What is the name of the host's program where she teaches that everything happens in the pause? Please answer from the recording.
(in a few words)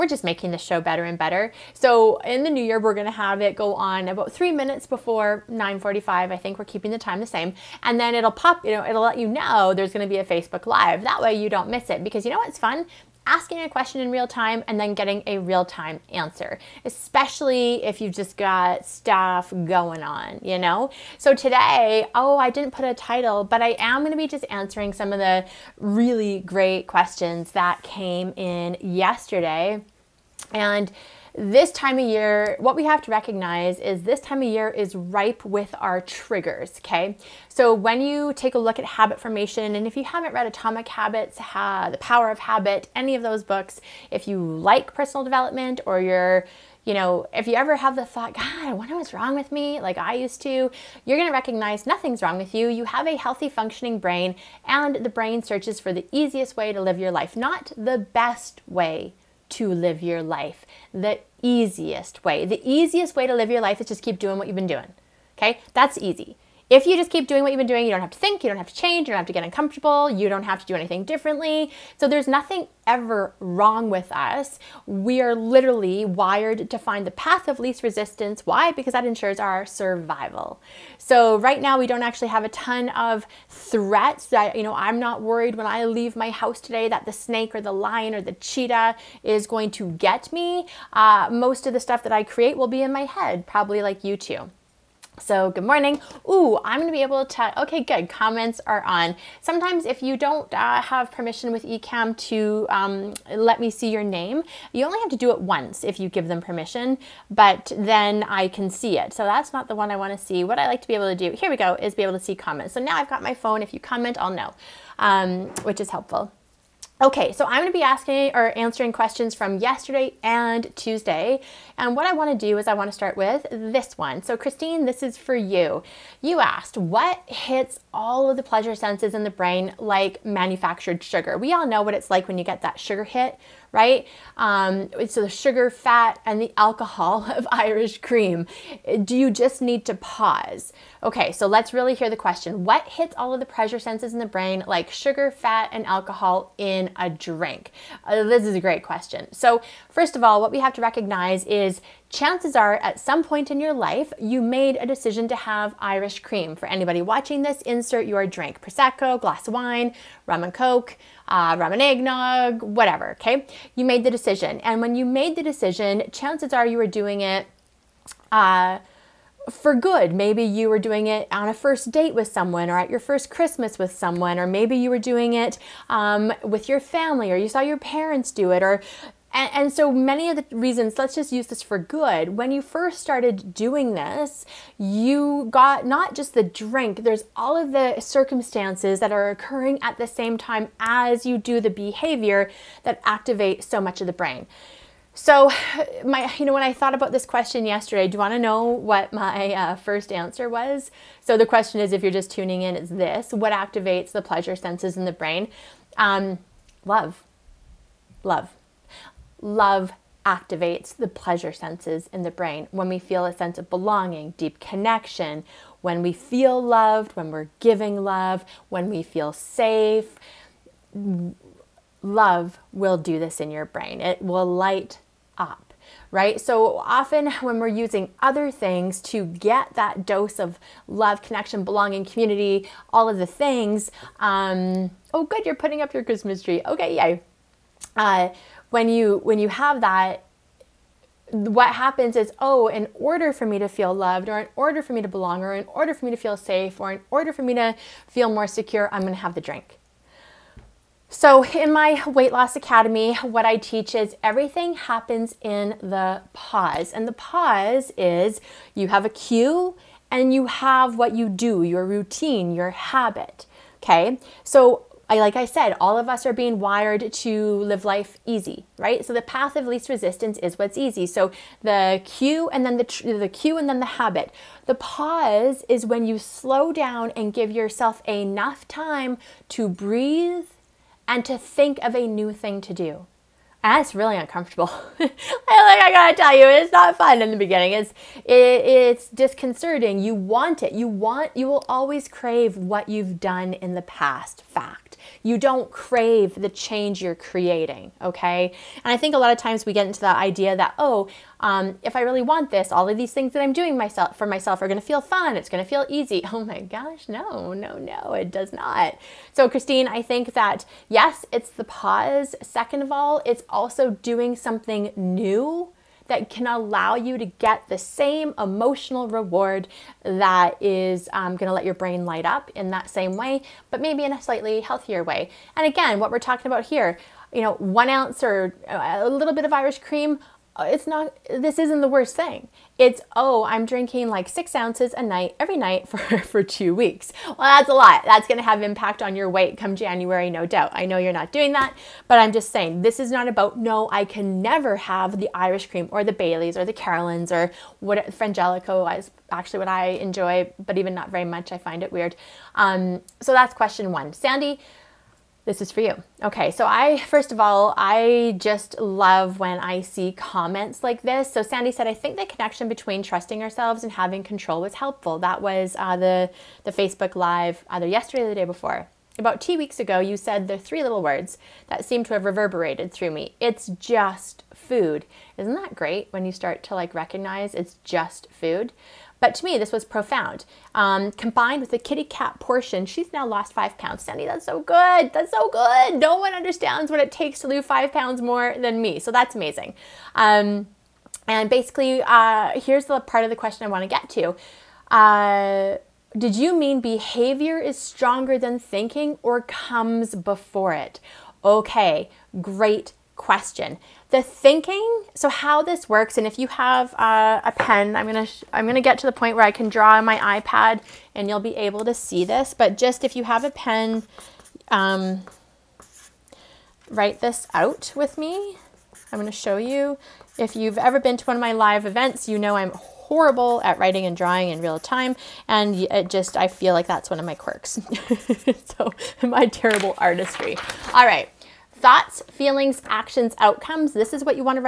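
Weight Loss Academy.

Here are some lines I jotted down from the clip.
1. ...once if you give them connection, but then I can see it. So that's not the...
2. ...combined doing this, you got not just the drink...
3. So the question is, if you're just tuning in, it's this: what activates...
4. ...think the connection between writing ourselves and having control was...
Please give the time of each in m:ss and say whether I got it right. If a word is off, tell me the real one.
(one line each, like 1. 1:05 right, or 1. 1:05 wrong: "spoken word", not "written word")
1. 1:45 wrong: "permission", not "connection"
2. 3:03 wrong: "started", not "combined"
3. 3:21 right
4. 6:01 wrong: "trusting", not "writing".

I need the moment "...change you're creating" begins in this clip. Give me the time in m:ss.
4:56.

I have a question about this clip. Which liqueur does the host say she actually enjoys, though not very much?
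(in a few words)
Frangelico.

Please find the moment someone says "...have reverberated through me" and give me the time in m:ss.
6:12.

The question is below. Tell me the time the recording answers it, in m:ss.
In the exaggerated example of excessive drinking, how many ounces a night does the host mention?
5:34.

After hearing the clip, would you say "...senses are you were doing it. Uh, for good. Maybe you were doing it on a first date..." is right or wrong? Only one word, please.
wrong.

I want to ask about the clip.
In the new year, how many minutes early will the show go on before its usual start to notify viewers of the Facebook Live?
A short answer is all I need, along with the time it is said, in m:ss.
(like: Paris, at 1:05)
3 minutes, at 0:04.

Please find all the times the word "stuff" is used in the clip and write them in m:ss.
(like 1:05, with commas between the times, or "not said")
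0:18, 1:31.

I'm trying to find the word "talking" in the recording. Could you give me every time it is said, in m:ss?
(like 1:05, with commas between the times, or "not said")
5:26.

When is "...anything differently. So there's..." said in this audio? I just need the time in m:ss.
1:10.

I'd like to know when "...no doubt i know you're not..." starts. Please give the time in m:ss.
5:40.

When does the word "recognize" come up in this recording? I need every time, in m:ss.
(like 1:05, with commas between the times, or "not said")
0:33, 0:51, 2:30, 6:16.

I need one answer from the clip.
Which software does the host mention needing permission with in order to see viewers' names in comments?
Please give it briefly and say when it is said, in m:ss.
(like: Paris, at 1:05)
eCamm, at 1:41.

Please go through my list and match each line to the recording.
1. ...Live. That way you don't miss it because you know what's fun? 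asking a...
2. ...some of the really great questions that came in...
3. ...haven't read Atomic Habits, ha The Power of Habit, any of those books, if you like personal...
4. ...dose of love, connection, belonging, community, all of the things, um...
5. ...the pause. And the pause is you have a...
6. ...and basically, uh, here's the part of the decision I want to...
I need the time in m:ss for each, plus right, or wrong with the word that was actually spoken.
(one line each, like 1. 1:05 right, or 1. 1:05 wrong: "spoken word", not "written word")
1. 0:10 right
2. 0:24 right
3. 0:40 right
4. 3:50 right
5. 4:15 right
6. 6:31 wrong: "question", not "decision".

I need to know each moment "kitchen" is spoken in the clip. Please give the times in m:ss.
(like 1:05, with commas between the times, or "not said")
not said.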